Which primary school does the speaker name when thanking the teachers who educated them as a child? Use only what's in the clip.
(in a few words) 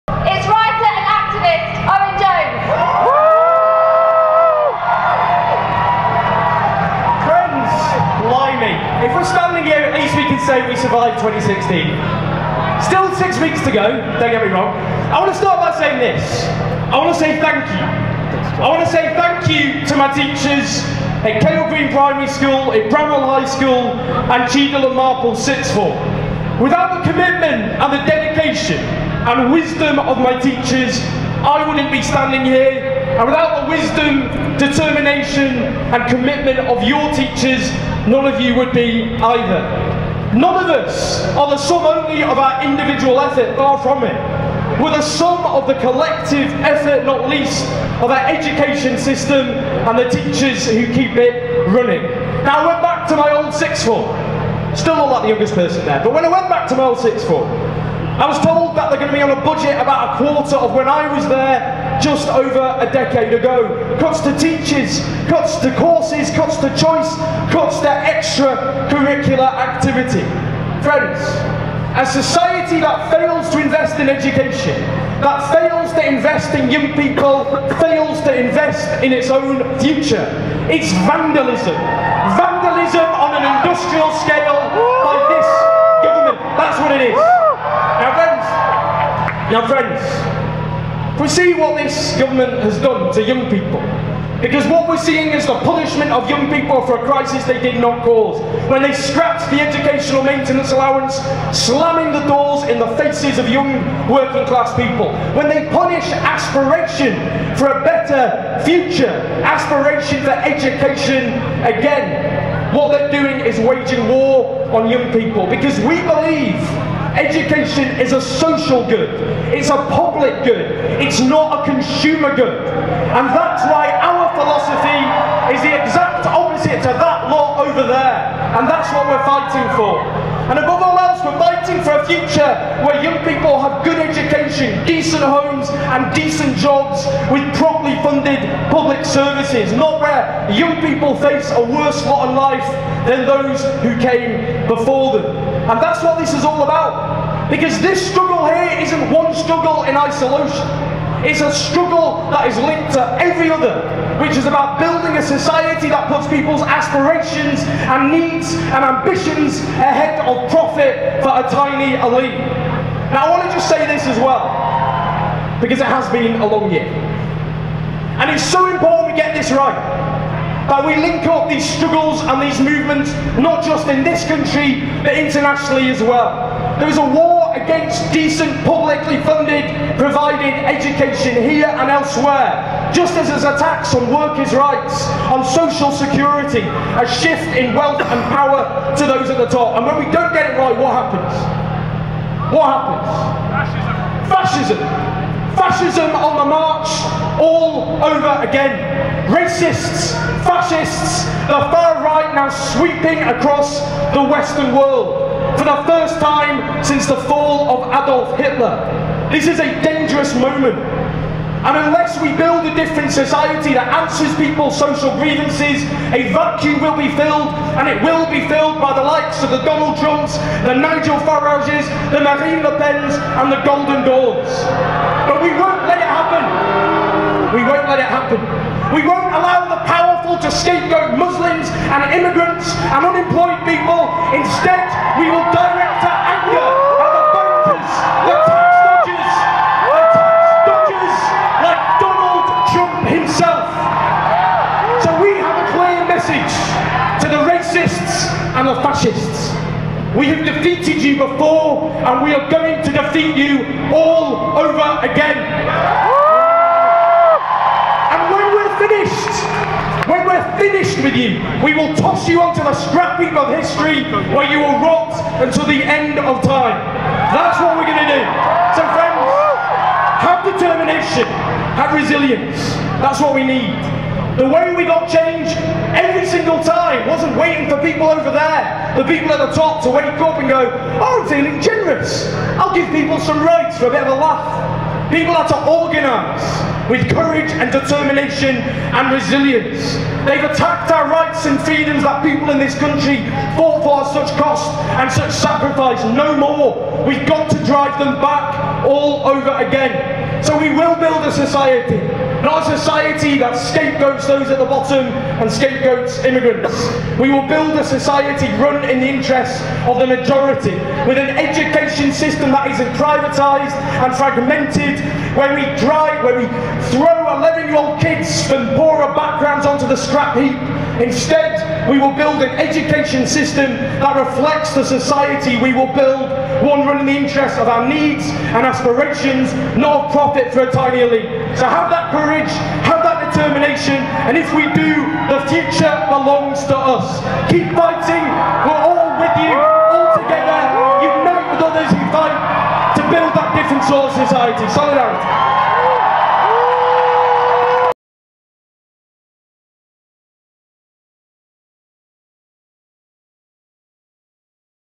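Cale Green Primary School.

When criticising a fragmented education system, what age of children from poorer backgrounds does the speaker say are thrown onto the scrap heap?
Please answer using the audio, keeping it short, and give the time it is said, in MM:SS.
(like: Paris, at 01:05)
11, at 05:17.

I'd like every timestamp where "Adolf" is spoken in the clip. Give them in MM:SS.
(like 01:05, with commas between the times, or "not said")
03:27.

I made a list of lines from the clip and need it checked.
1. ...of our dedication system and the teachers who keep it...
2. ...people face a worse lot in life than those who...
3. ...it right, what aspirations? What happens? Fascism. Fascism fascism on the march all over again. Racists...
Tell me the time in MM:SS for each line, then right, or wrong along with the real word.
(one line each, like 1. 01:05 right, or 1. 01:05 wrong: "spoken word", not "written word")
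1. 00:48 wrong: "education", not "dedication"
2. 02:20 right
3. 03:10 wrong: "happens", not "aspirations".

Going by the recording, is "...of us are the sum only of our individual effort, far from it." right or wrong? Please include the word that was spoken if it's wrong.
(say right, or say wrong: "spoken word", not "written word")
right.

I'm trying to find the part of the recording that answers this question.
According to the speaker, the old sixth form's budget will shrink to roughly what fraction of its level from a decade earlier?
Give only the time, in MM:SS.
01:00.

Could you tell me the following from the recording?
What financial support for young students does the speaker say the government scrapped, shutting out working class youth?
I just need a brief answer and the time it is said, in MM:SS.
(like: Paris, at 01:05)
educational maintenance allowance, at 01:39.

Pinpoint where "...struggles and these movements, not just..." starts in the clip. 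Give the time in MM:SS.
02:51.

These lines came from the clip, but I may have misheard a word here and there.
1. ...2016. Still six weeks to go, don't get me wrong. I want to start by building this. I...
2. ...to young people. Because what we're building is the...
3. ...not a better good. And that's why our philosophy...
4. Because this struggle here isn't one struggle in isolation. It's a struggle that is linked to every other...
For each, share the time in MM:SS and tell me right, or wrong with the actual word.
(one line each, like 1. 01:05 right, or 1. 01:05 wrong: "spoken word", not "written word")
1. 00:11 wrong: "saying", not "building"
2. 01:33 wrong: "seeing", not "building"
3. 02:01 wrong: "consumer", not "better"
4. 02:27 right.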